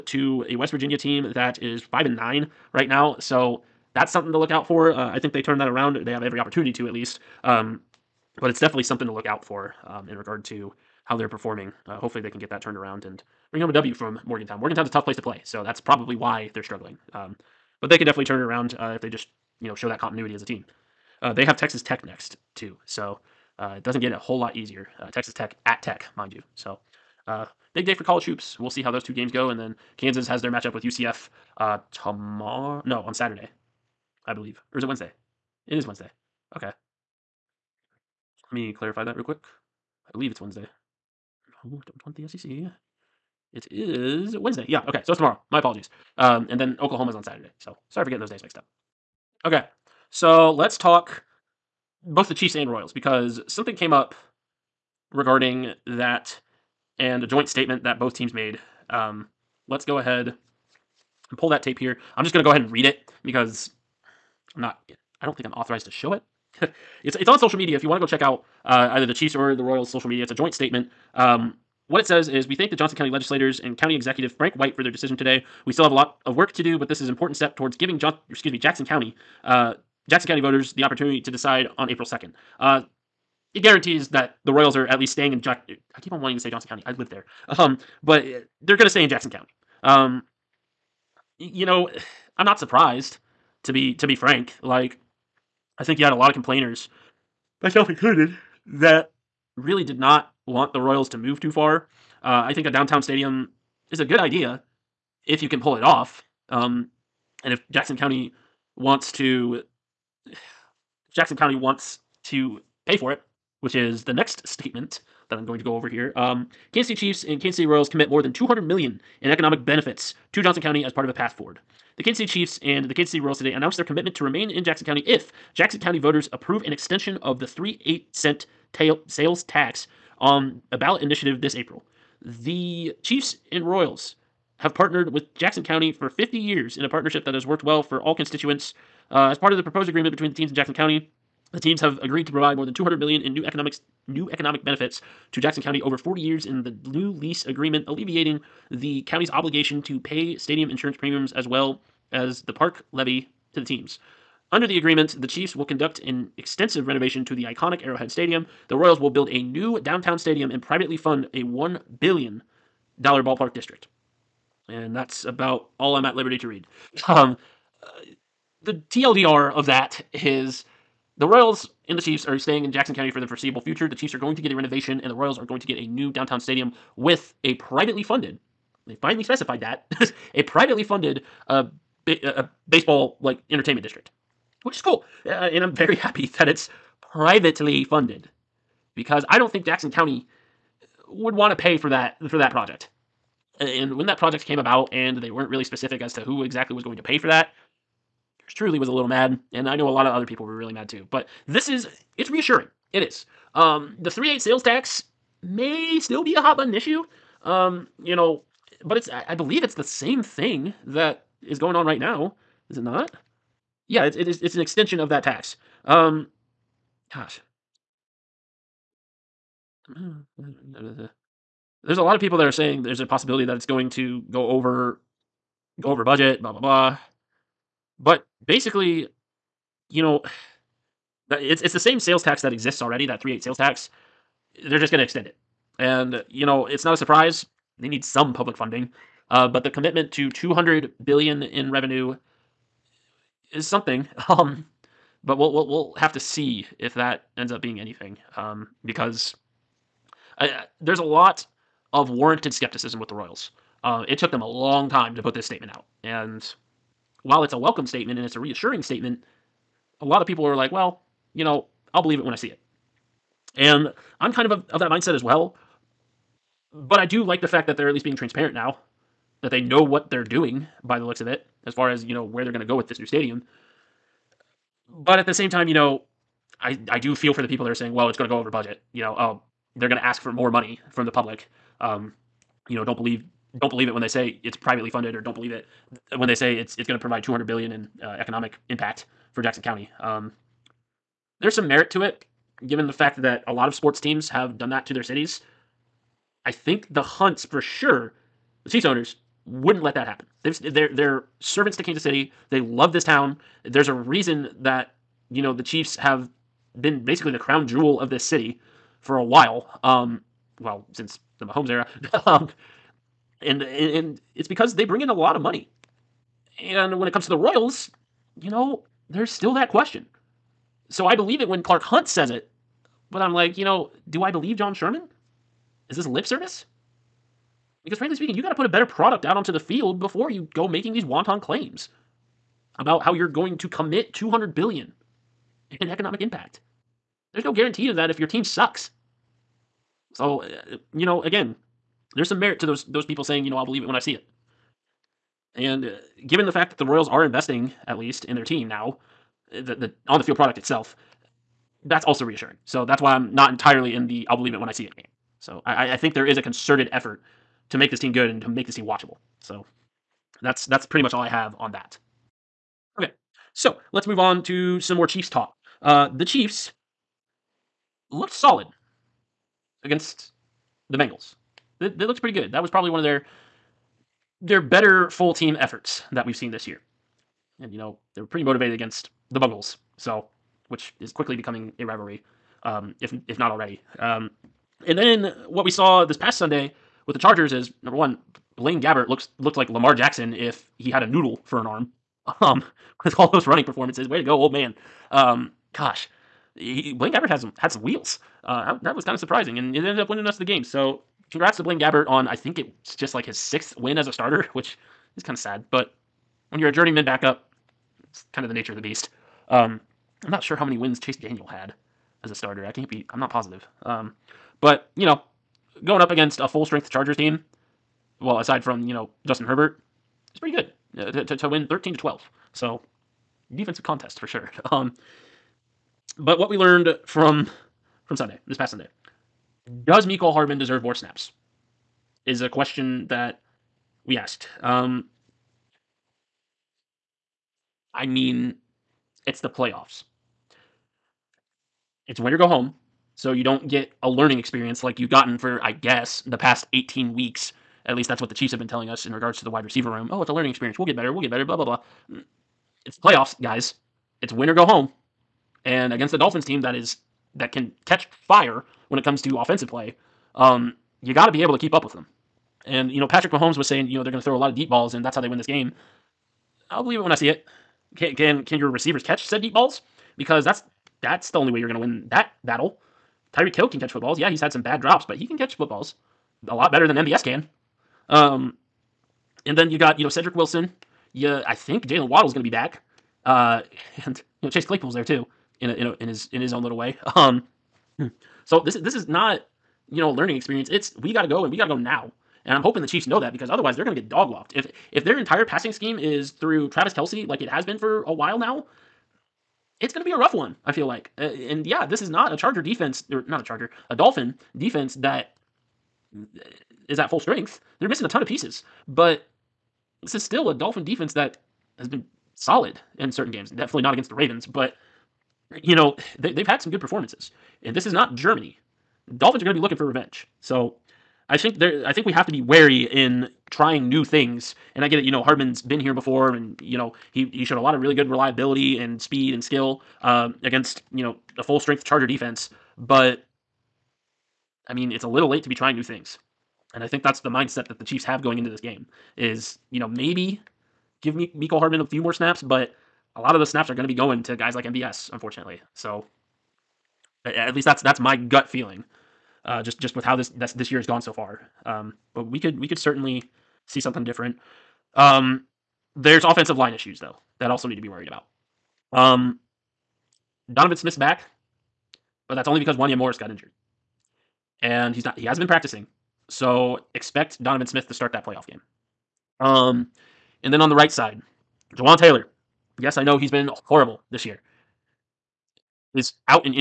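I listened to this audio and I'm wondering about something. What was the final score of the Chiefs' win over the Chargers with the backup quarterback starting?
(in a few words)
13-12.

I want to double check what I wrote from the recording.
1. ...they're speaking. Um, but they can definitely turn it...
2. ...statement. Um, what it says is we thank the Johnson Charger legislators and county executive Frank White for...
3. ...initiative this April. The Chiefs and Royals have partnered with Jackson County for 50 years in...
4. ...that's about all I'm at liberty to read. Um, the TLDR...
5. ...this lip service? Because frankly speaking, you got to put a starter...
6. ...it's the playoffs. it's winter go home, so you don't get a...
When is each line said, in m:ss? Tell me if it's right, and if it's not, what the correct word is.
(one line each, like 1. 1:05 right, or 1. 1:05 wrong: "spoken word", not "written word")
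1. 0:16 wrong: "struggling", not "speaking"
2. 1:10 wrong: "County", not "Charger"
3. 2:11 right
4. 2:44 right
5. 5:25 wrong: "better", not "starter"
6. 7:19 right.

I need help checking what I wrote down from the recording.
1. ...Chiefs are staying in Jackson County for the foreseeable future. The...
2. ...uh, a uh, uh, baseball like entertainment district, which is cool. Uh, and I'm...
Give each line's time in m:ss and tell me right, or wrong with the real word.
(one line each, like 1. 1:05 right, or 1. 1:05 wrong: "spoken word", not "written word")
1. 2:52 right
2. 3:01 right.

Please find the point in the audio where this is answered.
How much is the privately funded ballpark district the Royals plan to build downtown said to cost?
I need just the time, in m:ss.
2:41.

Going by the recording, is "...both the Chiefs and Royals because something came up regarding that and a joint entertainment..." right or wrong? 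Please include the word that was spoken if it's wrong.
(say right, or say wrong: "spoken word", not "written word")
wrong: "statement", not "entertainment".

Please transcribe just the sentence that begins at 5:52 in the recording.
So that's why I'm not entirely in the I'll believe it when I see it game.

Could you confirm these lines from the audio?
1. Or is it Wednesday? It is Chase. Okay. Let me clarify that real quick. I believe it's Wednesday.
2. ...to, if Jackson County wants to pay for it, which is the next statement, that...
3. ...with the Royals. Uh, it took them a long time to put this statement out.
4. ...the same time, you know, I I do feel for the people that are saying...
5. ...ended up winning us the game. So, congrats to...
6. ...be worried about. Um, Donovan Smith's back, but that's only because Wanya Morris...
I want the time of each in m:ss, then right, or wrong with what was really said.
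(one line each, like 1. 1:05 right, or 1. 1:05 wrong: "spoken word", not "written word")
1. 0:34 wrong: "Wednesday", not "Chase"
2. 1:49 right
3. 4:12 right
4. 4:35 right
5. 6:39 right
6. 9:17 right.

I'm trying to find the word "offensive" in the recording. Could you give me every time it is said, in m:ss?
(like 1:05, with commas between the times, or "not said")
7:39, 9:16.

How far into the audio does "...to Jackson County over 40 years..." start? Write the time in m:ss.
2:25.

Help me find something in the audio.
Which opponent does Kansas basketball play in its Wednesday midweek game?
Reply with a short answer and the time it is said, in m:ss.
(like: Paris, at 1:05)
UCF, at 0:30.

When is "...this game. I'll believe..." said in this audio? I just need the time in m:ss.
7:45.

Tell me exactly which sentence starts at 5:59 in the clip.
So that's that's pretty much all I have on that.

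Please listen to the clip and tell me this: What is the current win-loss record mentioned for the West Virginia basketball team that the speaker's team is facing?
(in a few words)
5-9.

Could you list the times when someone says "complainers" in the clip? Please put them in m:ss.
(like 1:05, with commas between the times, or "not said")
1:36.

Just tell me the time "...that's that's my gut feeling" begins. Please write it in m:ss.
9:07.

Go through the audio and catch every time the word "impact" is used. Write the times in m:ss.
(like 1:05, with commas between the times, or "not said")
4:48, 5:36.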